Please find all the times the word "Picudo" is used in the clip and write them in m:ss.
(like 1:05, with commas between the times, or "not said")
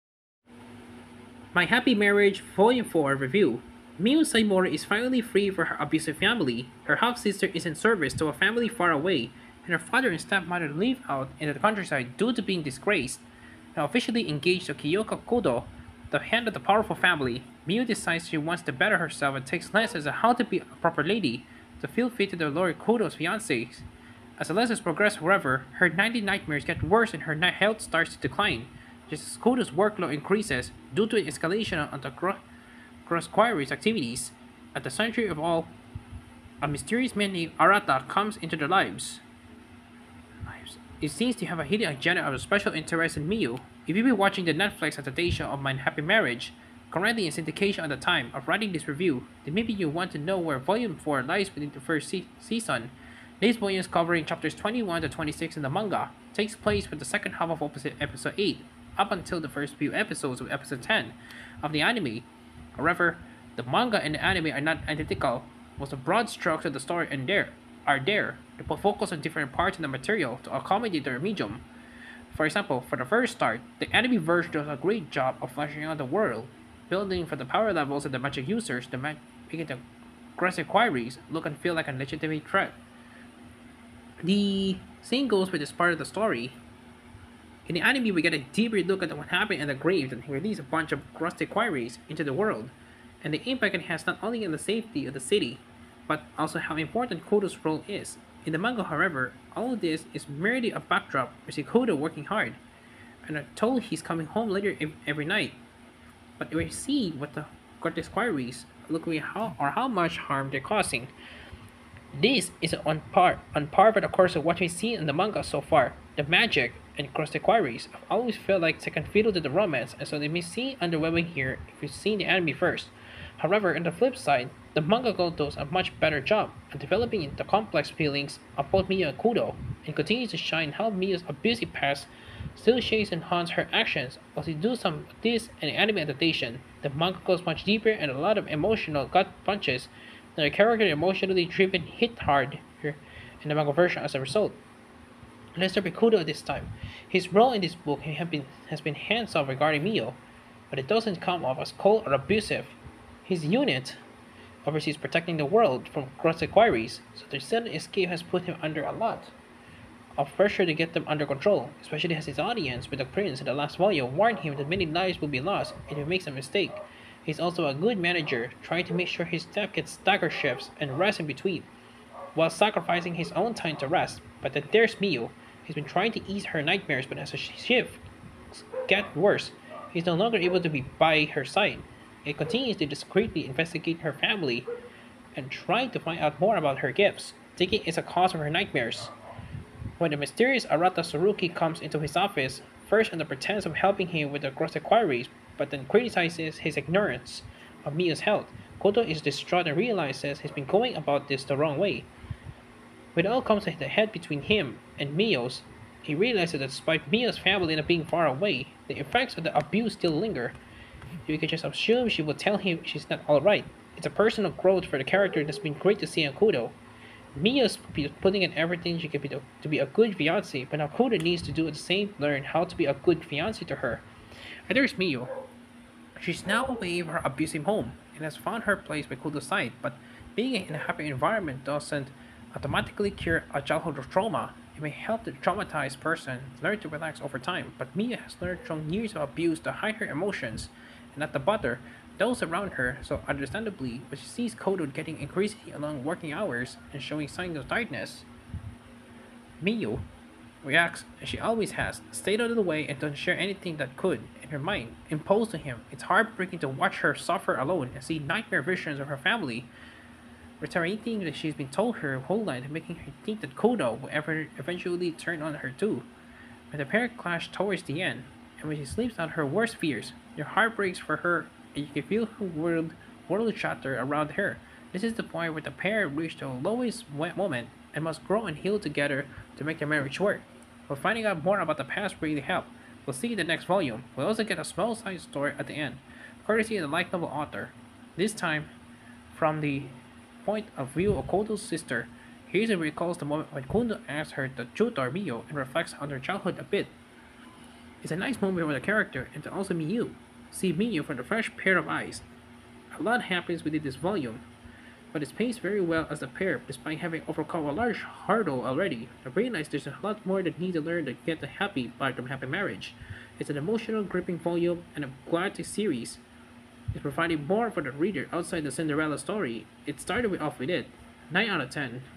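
2:25.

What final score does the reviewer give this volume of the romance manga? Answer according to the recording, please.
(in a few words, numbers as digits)
9 out of 10.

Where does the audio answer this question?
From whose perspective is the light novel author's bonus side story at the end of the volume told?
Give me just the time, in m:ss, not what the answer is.
4:51.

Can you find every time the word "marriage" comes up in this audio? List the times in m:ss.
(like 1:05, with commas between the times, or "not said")
0:01, 0:46, 4:39, 5:12.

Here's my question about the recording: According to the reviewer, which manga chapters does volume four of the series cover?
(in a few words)
21 to 26.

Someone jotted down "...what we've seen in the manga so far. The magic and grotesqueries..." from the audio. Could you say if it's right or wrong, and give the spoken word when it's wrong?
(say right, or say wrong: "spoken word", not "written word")
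right.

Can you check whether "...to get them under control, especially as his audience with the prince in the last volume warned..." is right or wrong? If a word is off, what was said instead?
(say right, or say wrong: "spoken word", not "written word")
right.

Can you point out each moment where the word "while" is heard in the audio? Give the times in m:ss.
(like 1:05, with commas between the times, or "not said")
1:05, 2:14, 2:52.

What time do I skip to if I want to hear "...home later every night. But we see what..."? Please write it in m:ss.
1:44.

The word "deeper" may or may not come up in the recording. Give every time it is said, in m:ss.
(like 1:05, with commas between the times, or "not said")
1:28, 2:17.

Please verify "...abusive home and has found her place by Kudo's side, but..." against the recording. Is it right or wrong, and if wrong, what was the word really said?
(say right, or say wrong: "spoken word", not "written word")
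right.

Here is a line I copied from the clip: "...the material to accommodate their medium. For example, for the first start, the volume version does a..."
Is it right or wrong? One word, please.
wrong.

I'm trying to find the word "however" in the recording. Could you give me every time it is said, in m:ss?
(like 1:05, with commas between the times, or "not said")
0:25, 1:02, 1:38, 2:03.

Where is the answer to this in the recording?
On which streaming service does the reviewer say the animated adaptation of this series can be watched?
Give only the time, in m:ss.
0:44.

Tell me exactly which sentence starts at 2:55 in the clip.
He's been trying to ease her nightmares, but as her shifts get worse, he's no longer able to be by her side.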